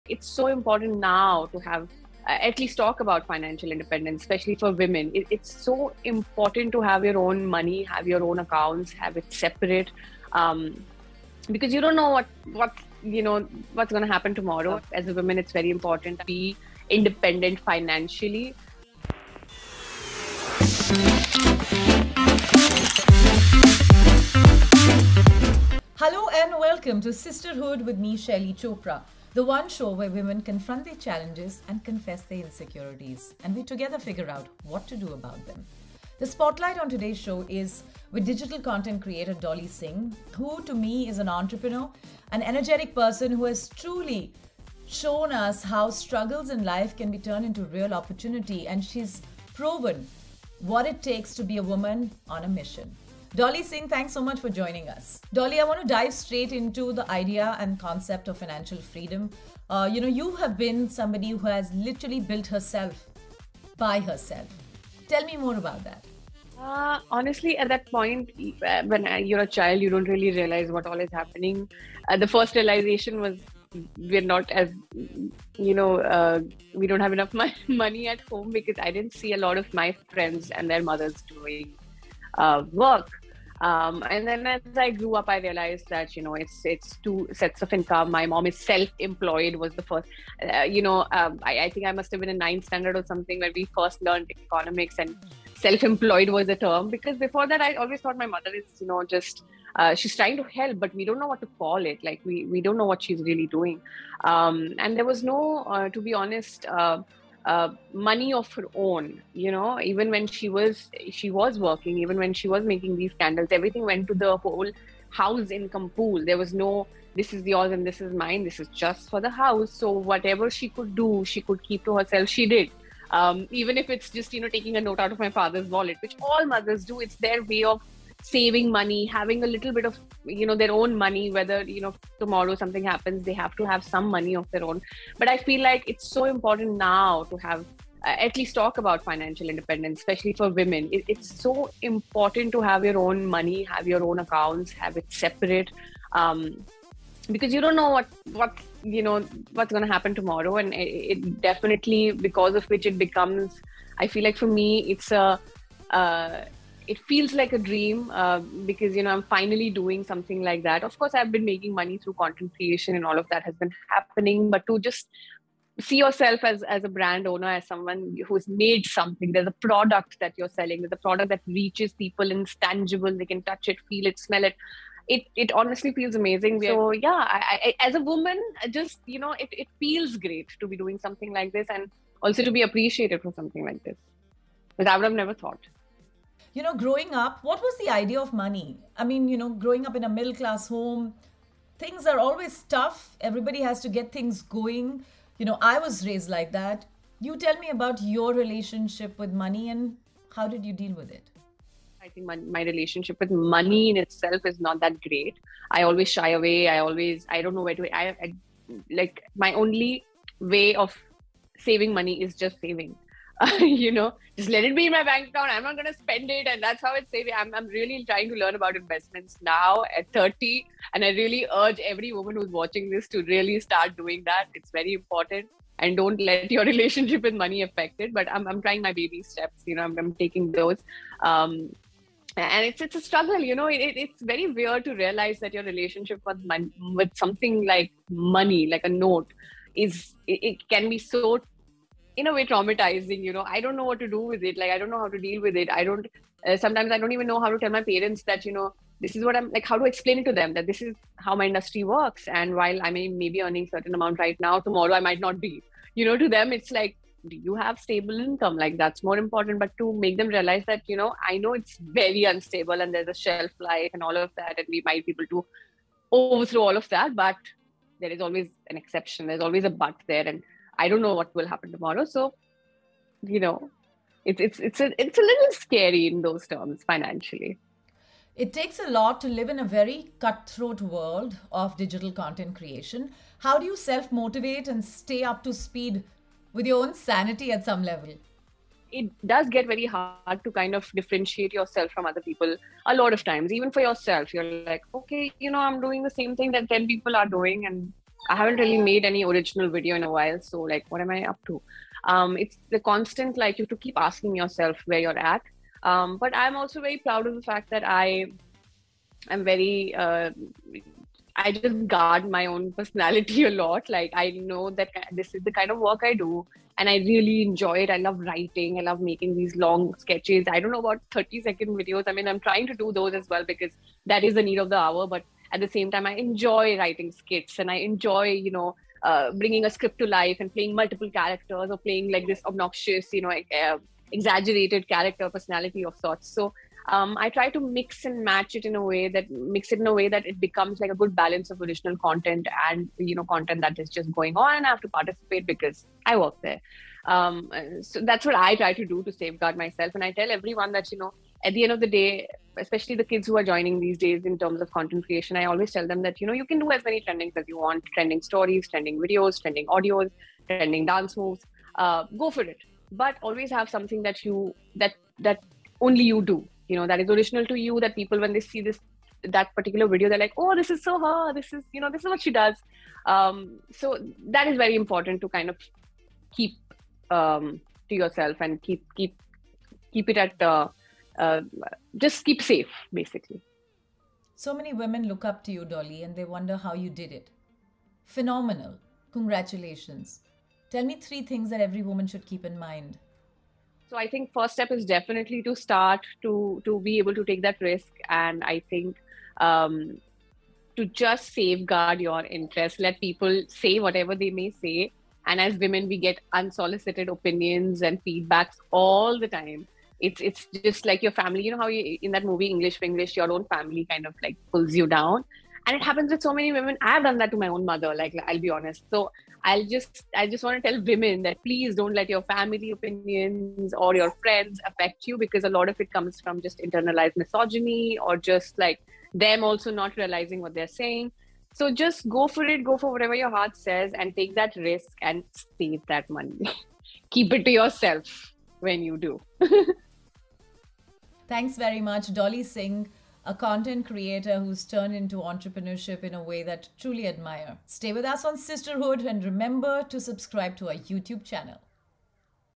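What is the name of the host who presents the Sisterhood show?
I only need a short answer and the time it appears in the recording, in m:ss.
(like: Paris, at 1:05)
Shaili Chopra, at 0:28.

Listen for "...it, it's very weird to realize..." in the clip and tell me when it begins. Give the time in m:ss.
3:53.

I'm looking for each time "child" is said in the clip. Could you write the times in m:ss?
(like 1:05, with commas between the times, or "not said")
1:09.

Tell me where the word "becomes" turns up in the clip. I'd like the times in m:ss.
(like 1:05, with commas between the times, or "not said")
2:32, 5:40.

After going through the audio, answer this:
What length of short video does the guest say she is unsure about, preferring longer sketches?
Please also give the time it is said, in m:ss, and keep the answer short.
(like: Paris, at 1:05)
30 second, at 5:21.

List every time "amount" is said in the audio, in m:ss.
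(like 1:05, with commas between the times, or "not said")
4:13.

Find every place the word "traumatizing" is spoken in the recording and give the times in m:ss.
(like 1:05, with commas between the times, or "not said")
4:02.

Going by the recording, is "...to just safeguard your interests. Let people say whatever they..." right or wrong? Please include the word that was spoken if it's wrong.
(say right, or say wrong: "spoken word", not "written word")
right.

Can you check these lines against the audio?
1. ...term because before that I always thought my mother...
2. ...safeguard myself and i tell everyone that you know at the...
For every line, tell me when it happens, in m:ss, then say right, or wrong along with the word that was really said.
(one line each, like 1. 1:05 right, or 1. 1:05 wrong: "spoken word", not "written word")
1. 1:36 right
2. 5:49 right.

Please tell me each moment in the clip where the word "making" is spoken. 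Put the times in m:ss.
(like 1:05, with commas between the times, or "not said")
1:52, 2:41, 5:19.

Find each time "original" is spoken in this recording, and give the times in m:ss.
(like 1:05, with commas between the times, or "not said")
4:59, 5:41, 6:07.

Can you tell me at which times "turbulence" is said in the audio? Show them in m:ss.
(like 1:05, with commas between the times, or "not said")
not said.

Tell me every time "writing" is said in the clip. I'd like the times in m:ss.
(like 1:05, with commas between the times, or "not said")
5:18, 5:26.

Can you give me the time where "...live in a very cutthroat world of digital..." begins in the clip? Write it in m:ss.
4:39.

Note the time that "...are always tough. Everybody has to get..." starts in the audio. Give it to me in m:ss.
3:12.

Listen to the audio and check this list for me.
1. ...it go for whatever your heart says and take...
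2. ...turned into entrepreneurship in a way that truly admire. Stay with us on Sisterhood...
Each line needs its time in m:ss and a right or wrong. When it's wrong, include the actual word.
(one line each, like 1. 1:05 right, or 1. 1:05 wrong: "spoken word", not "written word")
1. 7:12 right
2. 7:24 right.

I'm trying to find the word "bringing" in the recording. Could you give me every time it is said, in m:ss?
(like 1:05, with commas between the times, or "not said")
5:29.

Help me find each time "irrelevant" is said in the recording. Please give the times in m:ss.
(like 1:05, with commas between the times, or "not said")
not said.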